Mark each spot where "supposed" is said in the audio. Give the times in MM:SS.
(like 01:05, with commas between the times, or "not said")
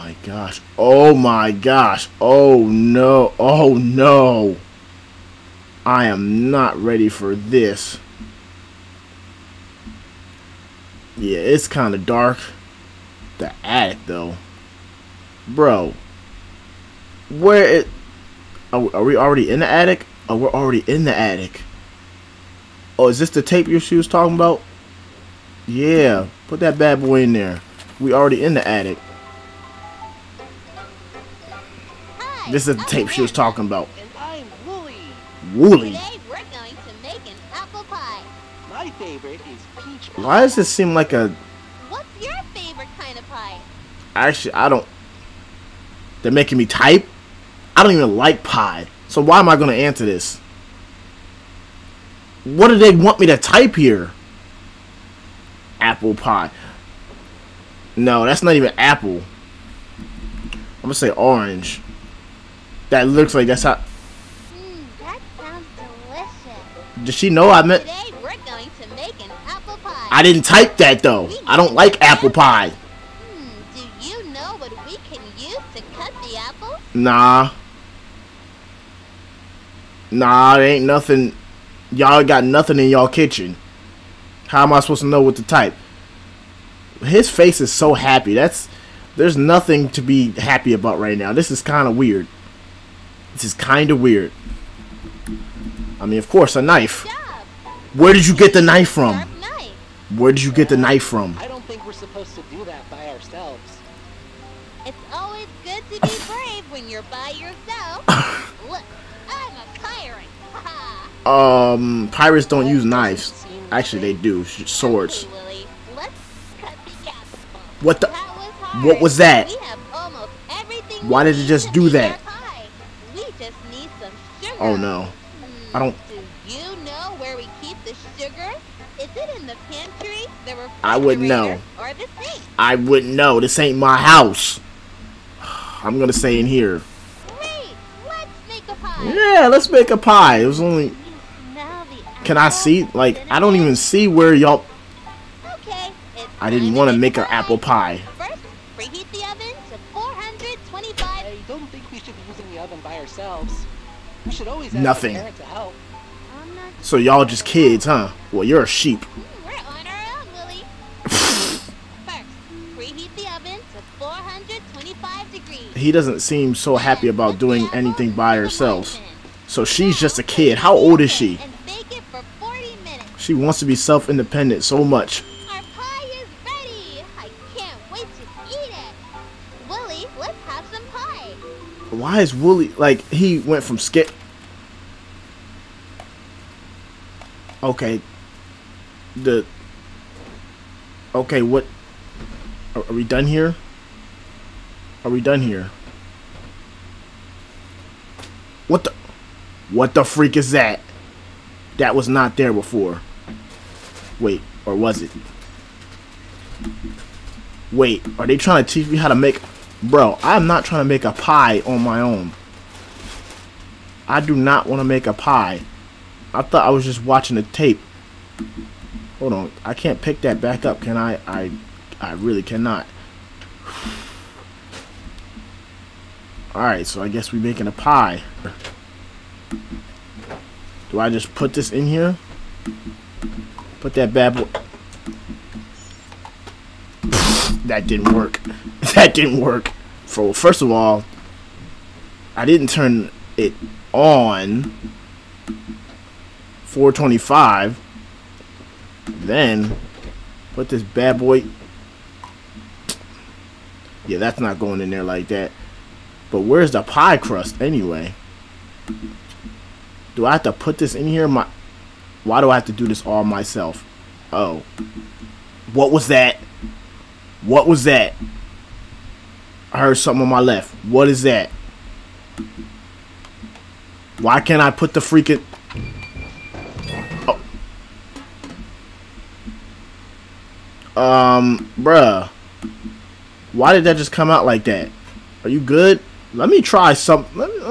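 01:24, 01:41.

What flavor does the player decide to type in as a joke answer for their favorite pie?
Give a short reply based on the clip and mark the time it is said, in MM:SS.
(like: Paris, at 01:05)
Orange, at 01:01.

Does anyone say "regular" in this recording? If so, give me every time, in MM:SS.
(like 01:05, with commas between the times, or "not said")
not said.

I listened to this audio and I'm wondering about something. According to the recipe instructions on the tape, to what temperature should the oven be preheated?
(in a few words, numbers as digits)
425 degrees.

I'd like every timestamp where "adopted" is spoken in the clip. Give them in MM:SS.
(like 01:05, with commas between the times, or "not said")
not said.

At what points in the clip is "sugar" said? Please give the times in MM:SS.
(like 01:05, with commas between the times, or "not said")
02:08.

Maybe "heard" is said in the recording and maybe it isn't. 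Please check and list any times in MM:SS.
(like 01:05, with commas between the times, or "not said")
04:29.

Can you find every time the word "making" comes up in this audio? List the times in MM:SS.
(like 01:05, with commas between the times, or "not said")
00:46, 03:47.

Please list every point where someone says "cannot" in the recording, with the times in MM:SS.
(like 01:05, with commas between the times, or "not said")
03:42.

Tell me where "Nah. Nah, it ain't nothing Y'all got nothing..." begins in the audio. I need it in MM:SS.
01:16.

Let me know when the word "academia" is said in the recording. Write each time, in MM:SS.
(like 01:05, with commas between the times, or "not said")
not said.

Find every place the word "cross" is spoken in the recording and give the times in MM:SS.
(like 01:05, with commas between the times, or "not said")
not said.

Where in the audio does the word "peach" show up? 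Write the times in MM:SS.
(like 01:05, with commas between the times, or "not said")
00:39.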